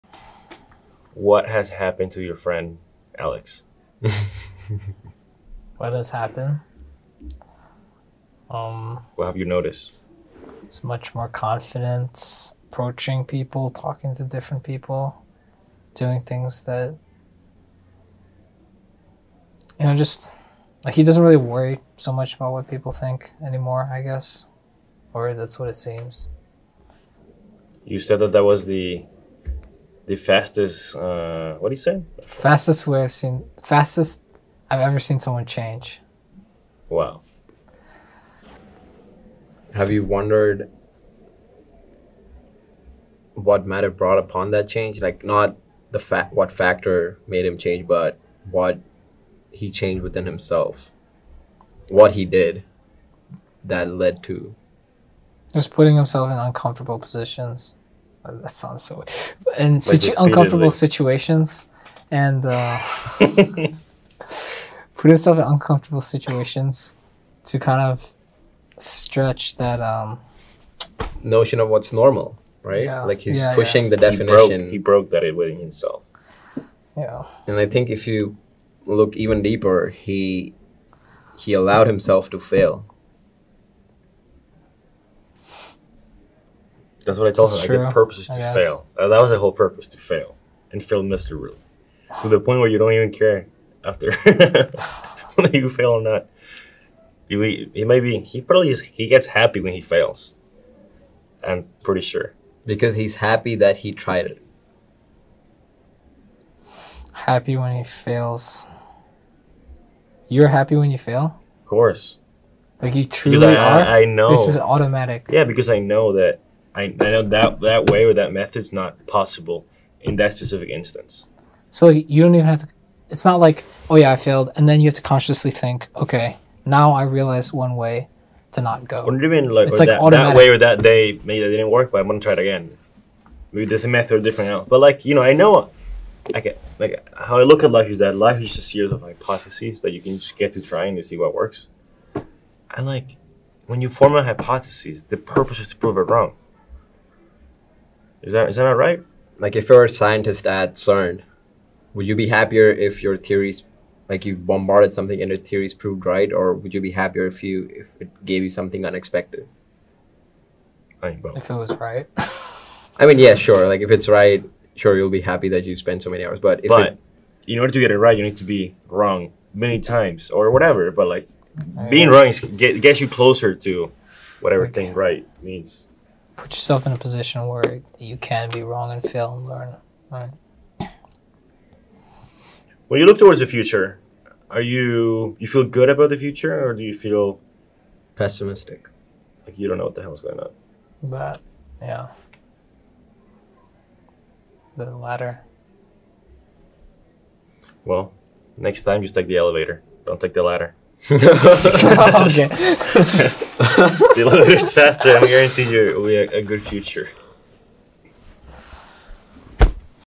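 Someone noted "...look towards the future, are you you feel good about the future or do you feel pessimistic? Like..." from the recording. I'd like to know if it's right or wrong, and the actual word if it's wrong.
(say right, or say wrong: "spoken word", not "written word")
right.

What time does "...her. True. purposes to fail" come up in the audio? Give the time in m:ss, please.
1:27.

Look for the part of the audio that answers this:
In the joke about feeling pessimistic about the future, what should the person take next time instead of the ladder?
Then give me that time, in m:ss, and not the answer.
3:19.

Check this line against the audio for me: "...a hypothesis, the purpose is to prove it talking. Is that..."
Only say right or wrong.
wrong.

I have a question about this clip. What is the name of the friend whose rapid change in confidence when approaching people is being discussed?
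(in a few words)
Alex.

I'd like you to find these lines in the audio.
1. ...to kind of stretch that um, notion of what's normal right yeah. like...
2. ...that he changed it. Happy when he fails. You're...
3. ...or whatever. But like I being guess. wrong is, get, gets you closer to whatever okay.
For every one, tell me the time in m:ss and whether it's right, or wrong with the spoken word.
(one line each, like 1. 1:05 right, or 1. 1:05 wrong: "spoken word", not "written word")
1. 1:07 right
2. 1:43 wrong: "tried", not "changed"
3. 2:50 right.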